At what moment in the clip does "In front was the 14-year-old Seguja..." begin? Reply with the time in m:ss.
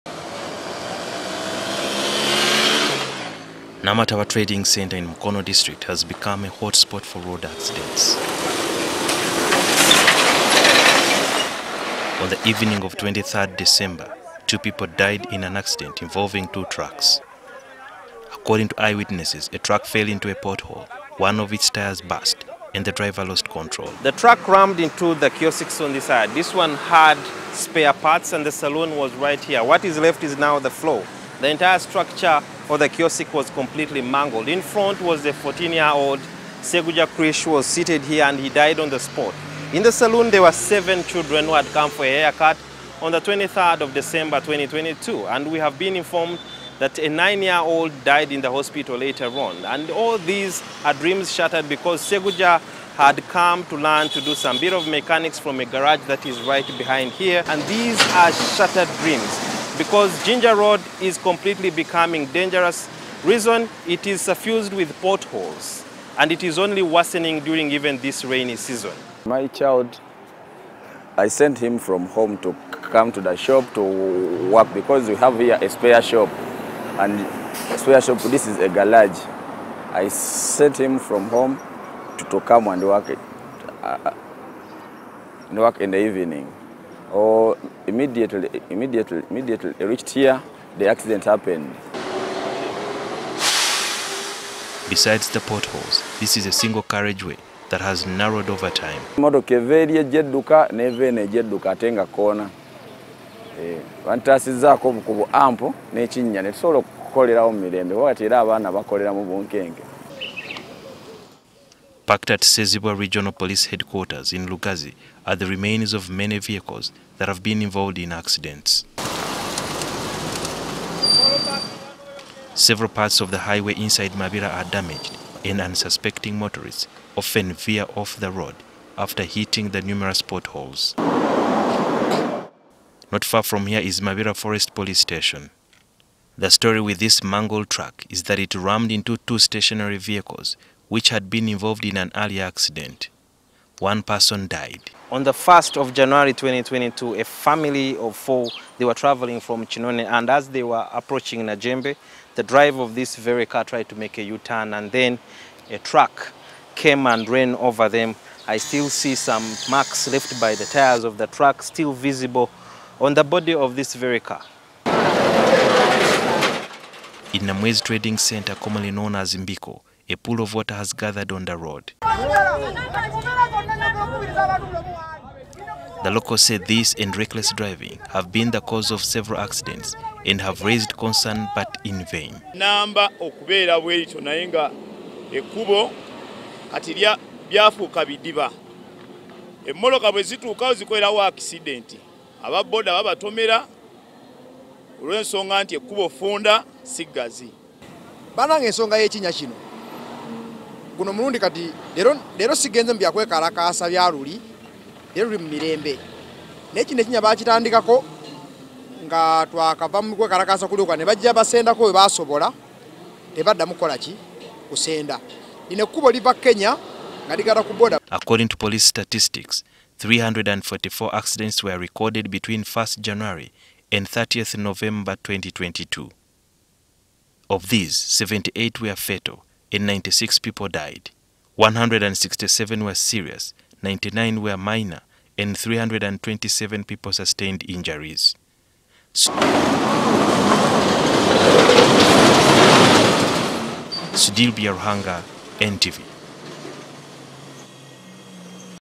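0:34.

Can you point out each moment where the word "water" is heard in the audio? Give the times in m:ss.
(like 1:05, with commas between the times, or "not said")
2:50.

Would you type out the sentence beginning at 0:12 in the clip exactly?
On the evening of 23rd December, two people died in an accident involving two trucks.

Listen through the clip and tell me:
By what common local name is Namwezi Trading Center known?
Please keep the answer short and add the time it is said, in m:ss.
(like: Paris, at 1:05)
Mbiko, at 2:49.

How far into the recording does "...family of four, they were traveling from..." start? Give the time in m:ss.
2:27.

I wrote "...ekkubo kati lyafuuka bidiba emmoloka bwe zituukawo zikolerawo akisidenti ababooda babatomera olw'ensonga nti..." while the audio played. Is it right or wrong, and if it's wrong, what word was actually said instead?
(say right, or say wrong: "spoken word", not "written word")
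right.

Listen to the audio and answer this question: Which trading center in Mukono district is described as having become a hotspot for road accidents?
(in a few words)
Namataba.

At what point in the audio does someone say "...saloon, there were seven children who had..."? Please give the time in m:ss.
0:39.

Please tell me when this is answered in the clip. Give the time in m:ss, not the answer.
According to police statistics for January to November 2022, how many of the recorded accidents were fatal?
3:47.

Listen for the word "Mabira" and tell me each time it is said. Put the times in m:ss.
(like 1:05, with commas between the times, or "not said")
2:04, 2:14.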